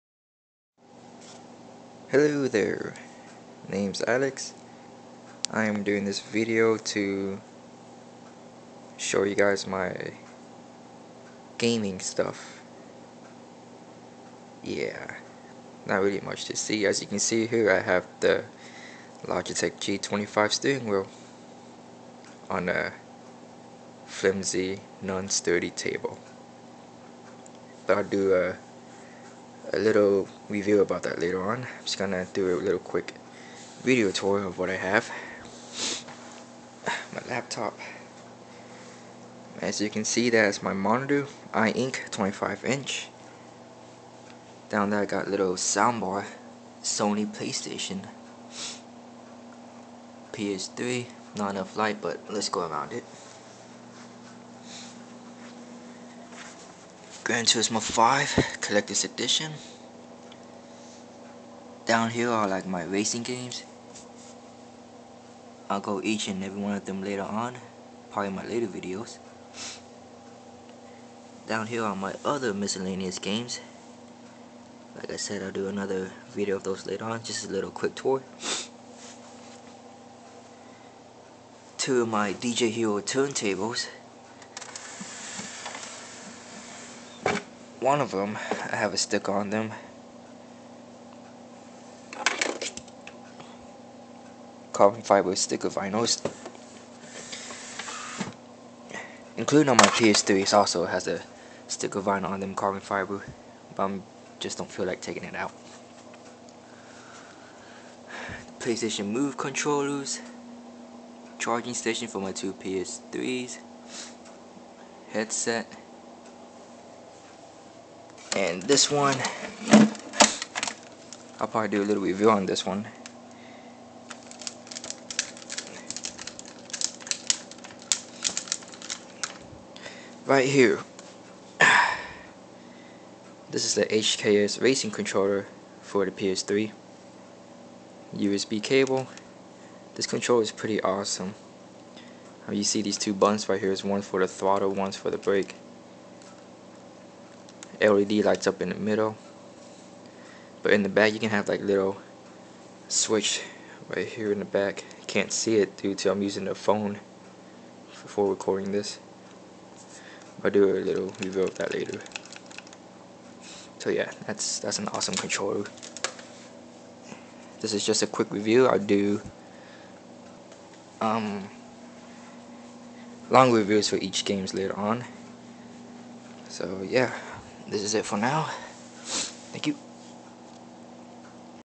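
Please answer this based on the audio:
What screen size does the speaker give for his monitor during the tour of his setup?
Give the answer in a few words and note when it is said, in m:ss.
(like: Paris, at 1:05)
25 inch, at 0:42.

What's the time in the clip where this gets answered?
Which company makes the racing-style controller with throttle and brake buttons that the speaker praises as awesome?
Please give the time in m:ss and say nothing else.
2:13.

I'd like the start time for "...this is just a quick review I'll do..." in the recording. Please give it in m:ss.
2:47.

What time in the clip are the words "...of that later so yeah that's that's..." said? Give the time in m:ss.
2:41.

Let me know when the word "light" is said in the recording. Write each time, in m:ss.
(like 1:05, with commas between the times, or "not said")
0:51, 2:28.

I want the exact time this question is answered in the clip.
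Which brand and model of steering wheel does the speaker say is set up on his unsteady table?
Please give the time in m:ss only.
0:19.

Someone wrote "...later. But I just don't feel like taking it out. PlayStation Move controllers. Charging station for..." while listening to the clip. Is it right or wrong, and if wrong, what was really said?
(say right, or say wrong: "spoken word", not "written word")
wrong: "fiber", not "later".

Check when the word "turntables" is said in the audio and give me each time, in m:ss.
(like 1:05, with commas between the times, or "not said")
1:22.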